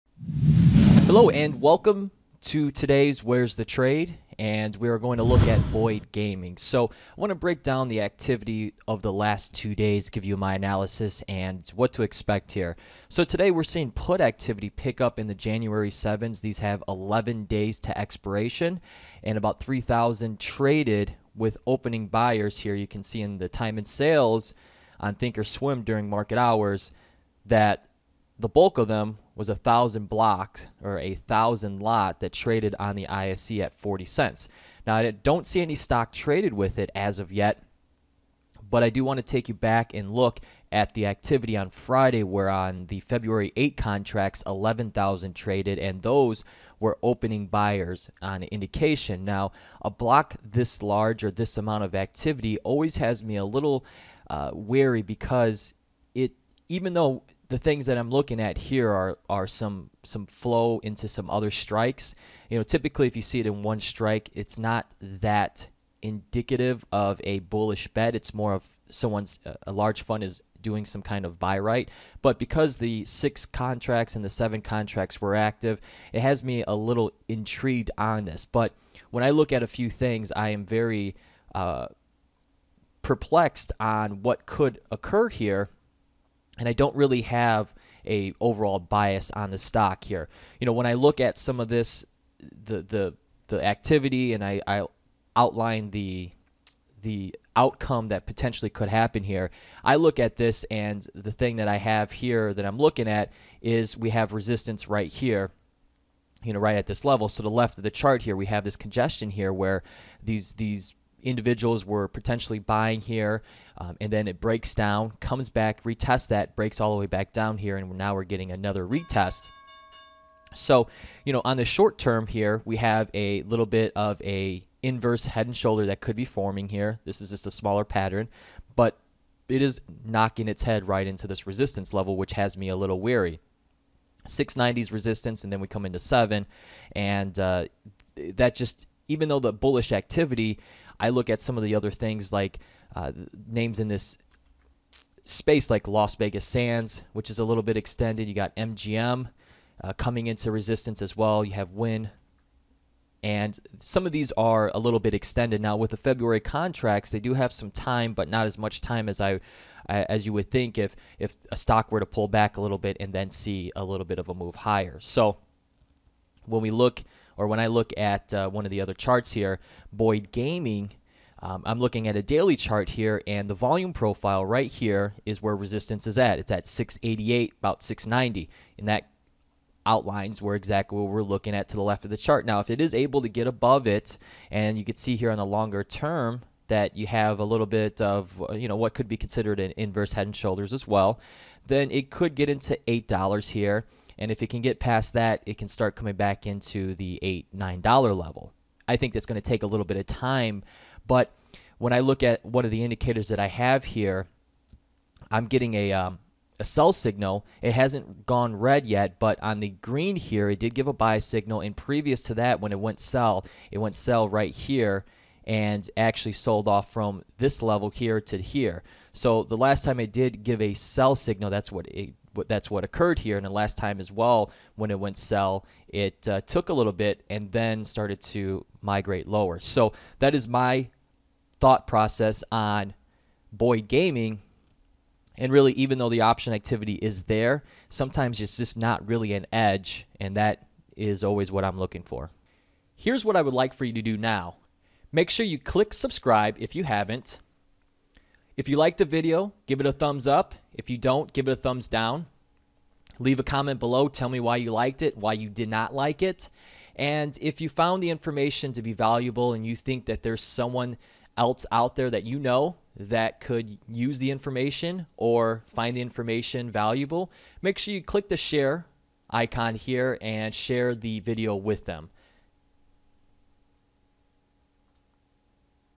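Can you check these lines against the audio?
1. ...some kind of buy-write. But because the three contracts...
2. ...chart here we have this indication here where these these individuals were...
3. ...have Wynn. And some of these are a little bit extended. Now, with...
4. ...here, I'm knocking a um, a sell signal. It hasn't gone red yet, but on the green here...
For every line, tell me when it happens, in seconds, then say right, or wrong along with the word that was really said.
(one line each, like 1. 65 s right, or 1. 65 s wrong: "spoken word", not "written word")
1. 70 s wrong: "six", not "three"
2. 107 s wrong: "congestion", not "indication"
3. 151 s right
4. 203 s wrong: "getting", not "knocking".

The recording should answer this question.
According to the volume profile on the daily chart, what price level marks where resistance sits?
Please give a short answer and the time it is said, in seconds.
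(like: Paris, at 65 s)
688, at 176 s.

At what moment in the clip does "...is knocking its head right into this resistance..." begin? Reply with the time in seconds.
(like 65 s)
129 s.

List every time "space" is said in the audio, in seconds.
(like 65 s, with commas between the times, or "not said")
145 s.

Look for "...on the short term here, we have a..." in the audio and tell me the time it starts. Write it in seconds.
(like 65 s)
121 s.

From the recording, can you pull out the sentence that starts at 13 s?
So today we're seeing put activity pick up in the January 7s.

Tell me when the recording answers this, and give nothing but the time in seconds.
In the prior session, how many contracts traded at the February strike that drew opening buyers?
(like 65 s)
44 s.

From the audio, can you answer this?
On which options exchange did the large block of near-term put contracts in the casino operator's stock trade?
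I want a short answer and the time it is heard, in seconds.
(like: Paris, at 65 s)
ISE, at 33 s.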